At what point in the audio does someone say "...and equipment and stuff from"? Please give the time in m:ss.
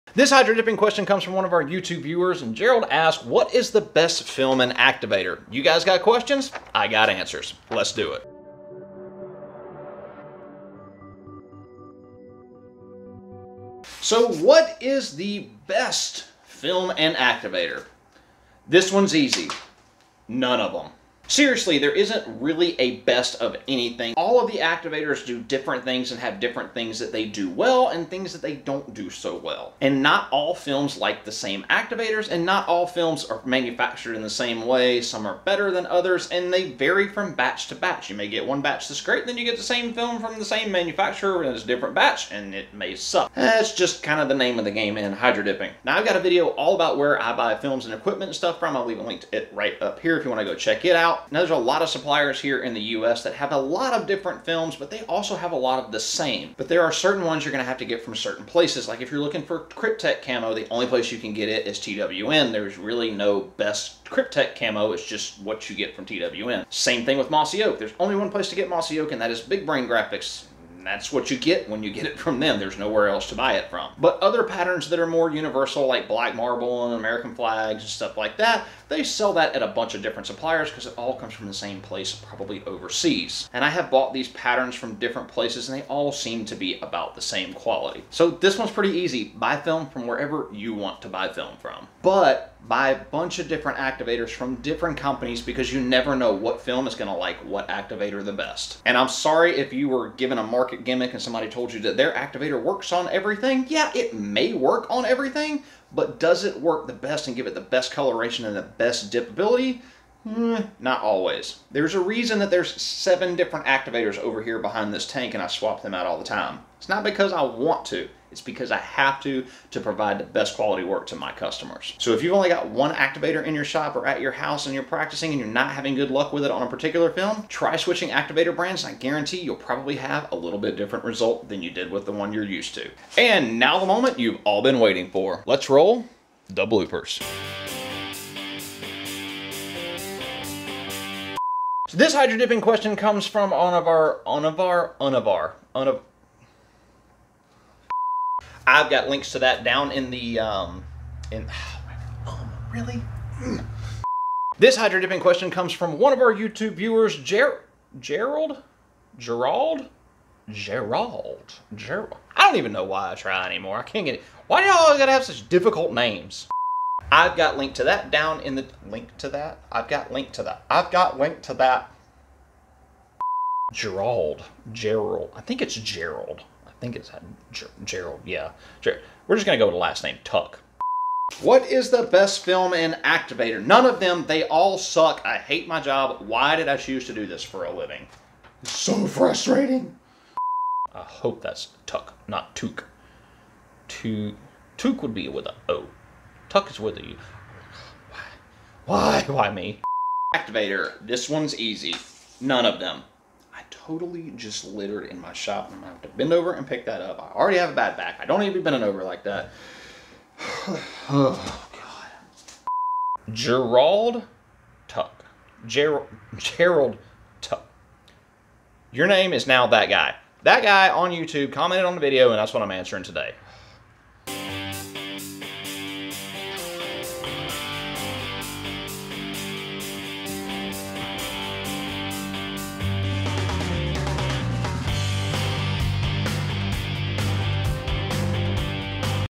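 0:47.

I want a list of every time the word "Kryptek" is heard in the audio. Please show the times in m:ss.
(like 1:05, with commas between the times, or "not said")
0:59, 1:04.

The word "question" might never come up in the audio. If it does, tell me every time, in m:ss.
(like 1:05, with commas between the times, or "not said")
0:00, 0:06, 2:22, 2:35.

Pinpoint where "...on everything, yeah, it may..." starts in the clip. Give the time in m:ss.
1:42.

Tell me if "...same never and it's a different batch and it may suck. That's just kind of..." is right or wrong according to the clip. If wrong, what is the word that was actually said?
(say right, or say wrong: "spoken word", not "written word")
wrong: "manufacturer", not "never".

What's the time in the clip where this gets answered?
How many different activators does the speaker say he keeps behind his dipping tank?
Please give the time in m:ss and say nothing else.
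1:52.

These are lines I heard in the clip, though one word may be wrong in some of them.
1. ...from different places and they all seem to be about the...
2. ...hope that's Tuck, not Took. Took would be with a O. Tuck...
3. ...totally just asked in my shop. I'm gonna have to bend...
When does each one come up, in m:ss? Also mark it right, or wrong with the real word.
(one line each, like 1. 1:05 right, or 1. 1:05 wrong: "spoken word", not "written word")
1. 1:24 right
2. 3:11 right
3. 3:23 wrong: "littered", not "asked".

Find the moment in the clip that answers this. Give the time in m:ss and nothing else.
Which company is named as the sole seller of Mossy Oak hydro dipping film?
1:09.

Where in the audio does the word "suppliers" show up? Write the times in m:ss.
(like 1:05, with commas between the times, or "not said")
0:51, 1:20.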